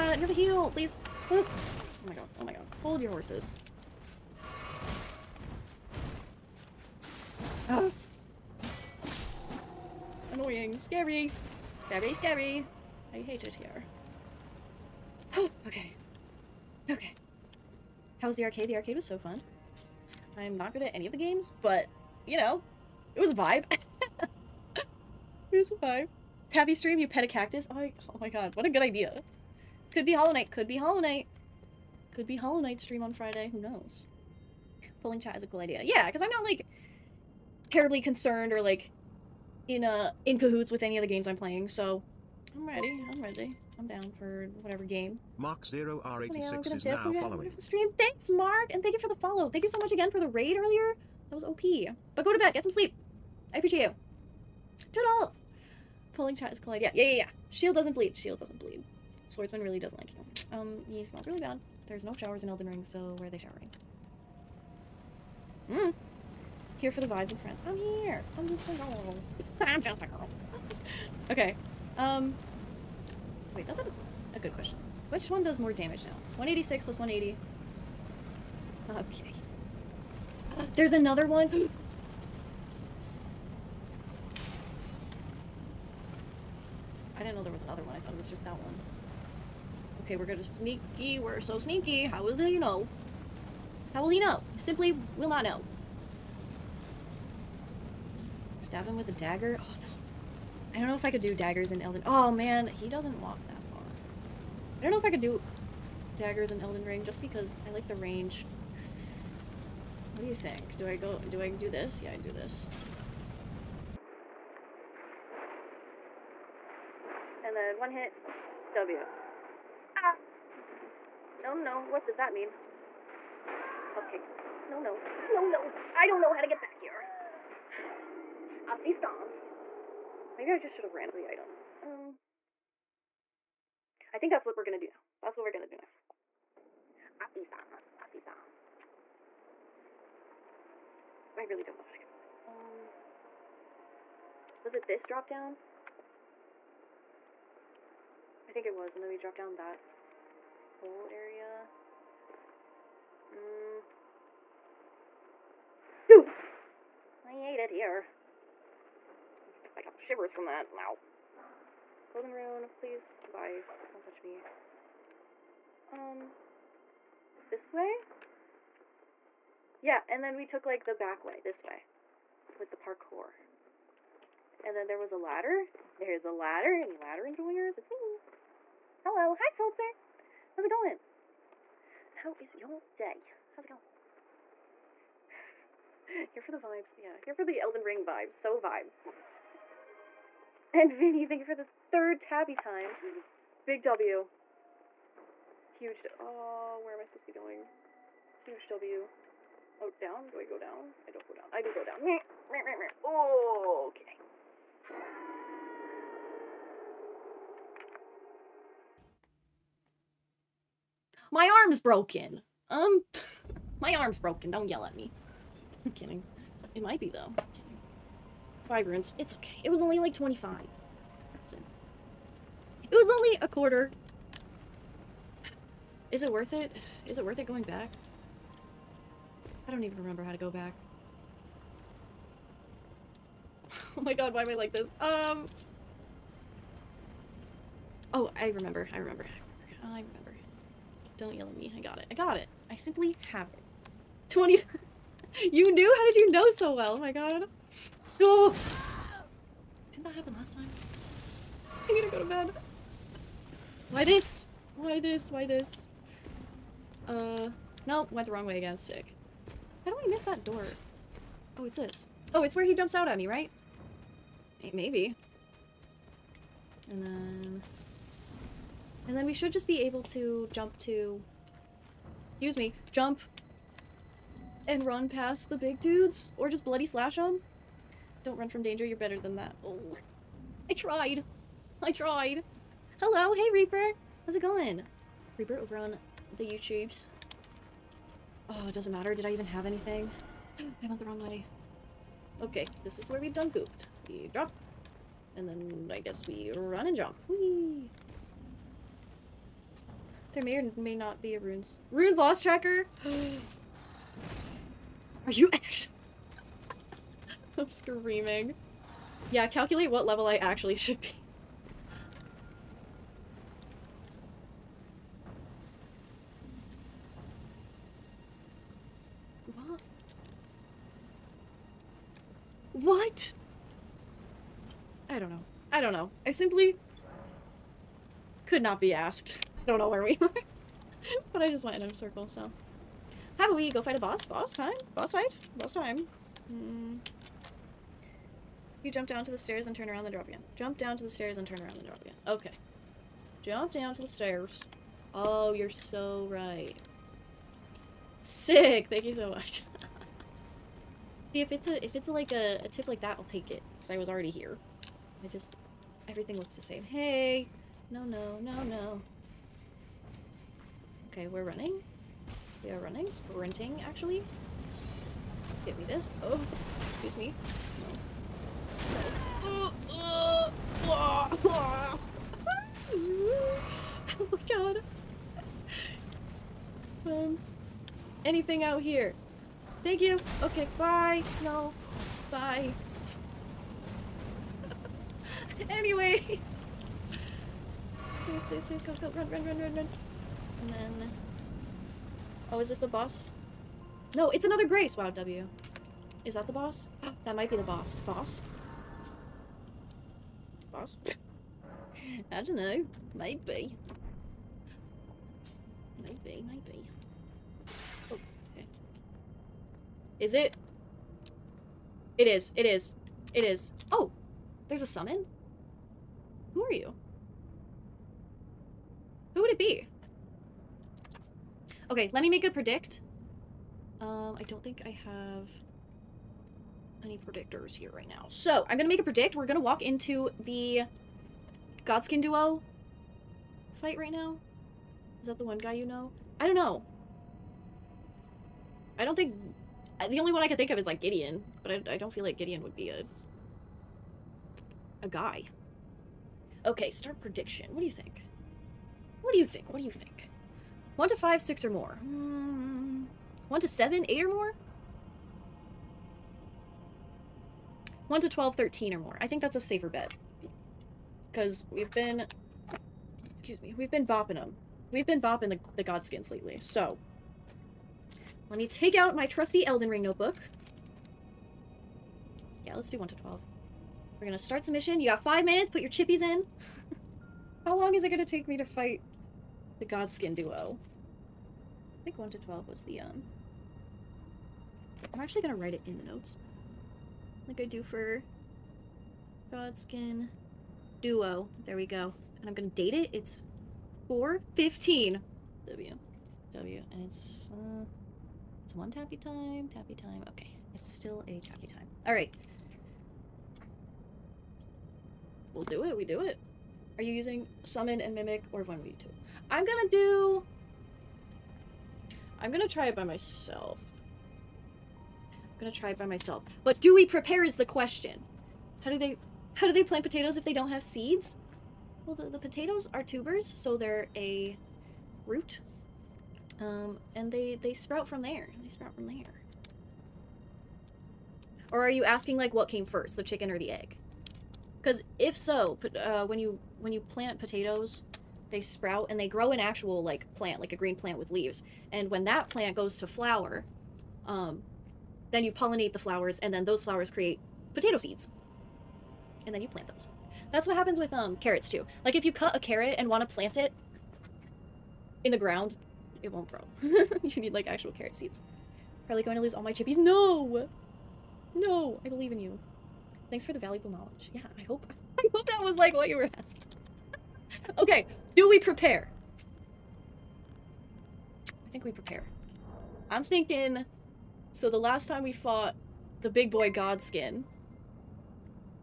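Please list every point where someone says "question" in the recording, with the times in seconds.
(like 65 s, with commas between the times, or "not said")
74 s, 517 s.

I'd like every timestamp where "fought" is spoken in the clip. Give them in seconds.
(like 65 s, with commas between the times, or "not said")
575 s.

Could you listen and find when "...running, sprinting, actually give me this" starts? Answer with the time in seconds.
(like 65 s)
362 s.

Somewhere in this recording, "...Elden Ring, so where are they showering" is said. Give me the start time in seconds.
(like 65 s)
62 s.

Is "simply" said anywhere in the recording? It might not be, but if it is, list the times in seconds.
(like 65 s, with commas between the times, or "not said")
94 s, 242 s, 326 s.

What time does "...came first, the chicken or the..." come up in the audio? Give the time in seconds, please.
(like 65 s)
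532 s.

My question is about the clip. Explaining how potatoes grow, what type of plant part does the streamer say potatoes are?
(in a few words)
Tubers.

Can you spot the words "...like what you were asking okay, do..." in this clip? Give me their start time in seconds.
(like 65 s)
565 s.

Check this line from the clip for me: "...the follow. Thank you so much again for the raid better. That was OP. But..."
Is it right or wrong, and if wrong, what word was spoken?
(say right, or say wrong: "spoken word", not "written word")
wrong: "earlier", not "better".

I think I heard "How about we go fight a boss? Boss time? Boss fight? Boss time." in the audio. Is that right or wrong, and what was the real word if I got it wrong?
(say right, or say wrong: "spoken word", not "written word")
right.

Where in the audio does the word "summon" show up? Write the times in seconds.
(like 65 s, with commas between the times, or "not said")
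414 s, 507 s.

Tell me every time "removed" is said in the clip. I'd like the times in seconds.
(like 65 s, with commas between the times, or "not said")
not said.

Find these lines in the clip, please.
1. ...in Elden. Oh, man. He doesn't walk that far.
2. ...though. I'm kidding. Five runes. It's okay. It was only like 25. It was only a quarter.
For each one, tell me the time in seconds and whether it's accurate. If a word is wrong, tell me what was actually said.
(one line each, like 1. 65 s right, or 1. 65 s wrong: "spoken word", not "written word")
1. 101 s right
2. 217 s right.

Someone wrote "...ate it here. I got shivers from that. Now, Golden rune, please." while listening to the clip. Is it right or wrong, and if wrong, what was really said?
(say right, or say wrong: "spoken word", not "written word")
right.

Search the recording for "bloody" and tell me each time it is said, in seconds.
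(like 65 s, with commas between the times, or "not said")
276 s.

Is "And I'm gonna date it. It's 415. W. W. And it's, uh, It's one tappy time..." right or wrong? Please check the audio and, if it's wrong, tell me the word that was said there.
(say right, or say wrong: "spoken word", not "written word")
right.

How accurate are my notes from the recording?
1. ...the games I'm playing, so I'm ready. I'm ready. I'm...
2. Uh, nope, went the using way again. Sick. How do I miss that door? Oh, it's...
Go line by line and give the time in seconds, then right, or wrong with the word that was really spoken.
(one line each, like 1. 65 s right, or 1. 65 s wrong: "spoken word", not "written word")
1. 41 s right
2. 257 s wrong: "wrong", not "using".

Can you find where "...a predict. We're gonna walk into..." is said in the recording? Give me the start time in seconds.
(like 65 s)
428 s.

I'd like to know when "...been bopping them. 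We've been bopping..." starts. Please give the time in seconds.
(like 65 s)
463 s.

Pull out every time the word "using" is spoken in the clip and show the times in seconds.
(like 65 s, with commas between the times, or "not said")
507 s.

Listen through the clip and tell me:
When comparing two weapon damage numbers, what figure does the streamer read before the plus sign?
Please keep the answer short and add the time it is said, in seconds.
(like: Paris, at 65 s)
186, at 76 s.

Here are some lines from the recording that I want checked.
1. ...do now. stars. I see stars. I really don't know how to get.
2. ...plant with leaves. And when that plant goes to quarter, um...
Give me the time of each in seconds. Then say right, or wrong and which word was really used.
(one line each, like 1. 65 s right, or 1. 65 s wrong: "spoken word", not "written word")
1. 135 s right
2. 540 s wrong: "flower", not "quarter".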